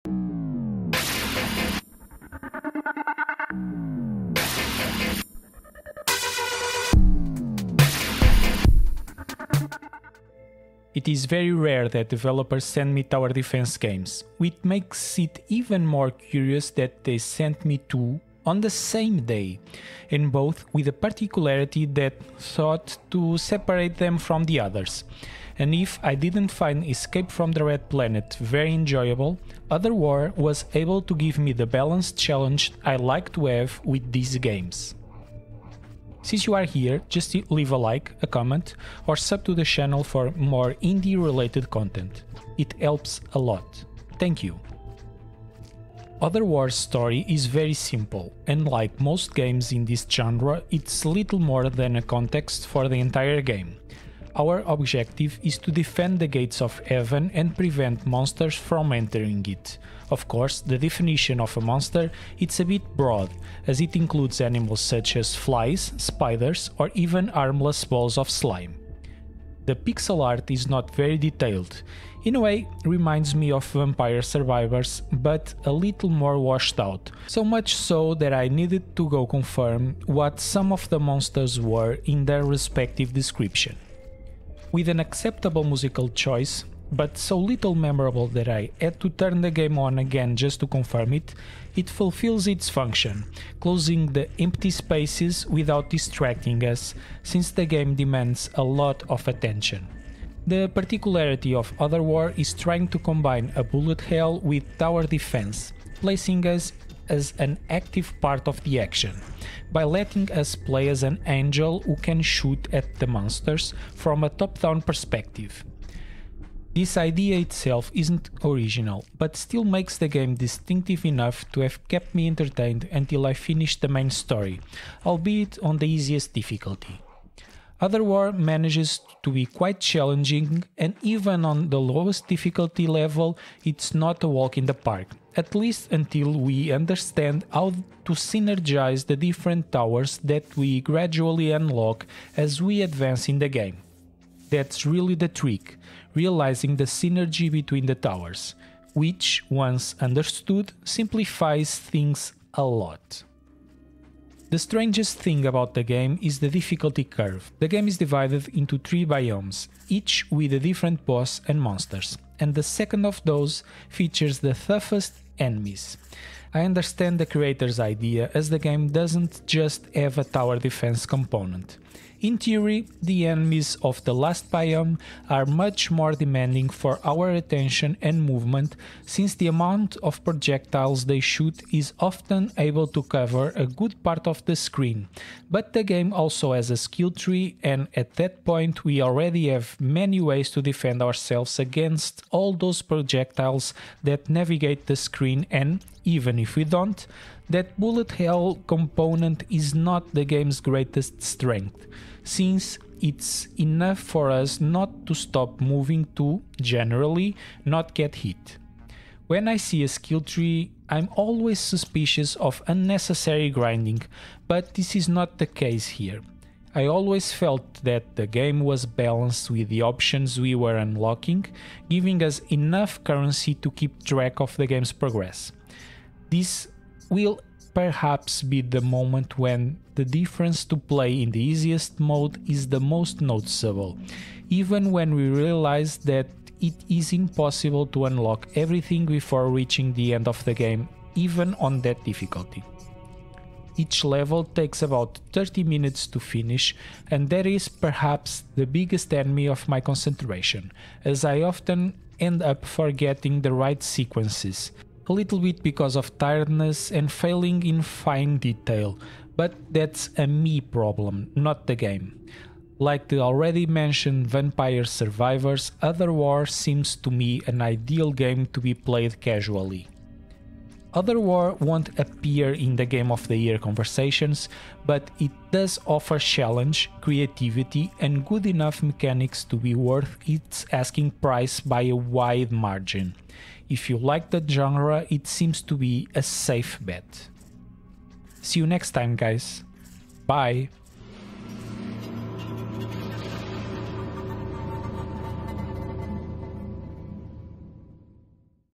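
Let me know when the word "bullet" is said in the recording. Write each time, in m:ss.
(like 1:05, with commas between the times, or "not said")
1:43, 3:17.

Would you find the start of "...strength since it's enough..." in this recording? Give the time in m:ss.
3:21.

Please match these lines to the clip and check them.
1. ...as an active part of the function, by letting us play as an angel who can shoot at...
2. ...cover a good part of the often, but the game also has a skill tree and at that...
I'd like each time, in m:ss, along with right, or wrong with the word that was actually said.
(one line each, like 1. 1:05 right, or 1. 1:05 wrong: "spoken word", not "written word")
1. 1:47 wrong: "action", not "function"
2. 3:03 wrong: "screen", not "often".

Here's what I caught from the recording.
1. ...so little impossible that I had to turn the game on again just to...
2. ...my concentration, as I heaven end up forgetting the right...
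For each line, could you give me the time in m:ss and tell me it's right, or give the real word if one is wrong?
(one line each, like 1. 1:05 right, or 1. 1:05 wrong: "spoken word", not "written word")
1. 1:27 wrong: "memorable", not "impossible"
2. 4:09 wrong: "often", not "heaven".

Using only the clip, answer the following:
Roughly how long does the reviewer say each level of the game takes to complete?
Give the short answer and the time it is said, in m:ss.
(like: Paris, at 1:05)
30 minutes, at 4:05.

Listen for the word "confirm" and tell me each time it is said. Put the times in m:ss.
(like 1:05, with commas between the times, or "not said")
1:19, 1:30.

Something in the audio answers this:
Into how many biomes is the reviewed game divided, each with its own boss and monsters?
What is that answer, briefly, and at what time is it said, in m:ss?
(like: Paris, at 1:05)
3, at 2:38.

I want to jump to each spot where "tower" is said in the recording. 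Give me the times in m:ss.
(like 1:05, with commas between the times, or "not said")
0:13, 1:44, 2:19, 2:27, 2:50.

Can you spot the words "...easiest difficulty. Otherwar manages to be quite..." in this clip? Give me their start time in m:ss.
2:05.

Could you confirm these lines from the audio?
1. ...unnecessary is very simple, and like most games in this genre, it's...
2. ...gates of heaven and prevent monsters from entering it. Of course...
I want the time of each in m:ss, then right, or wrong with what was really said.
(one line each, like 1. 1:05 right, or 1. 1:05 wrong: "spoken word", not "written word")
1. 0:46 wrong: "story", not "unnecessary"
2. 0:56 right.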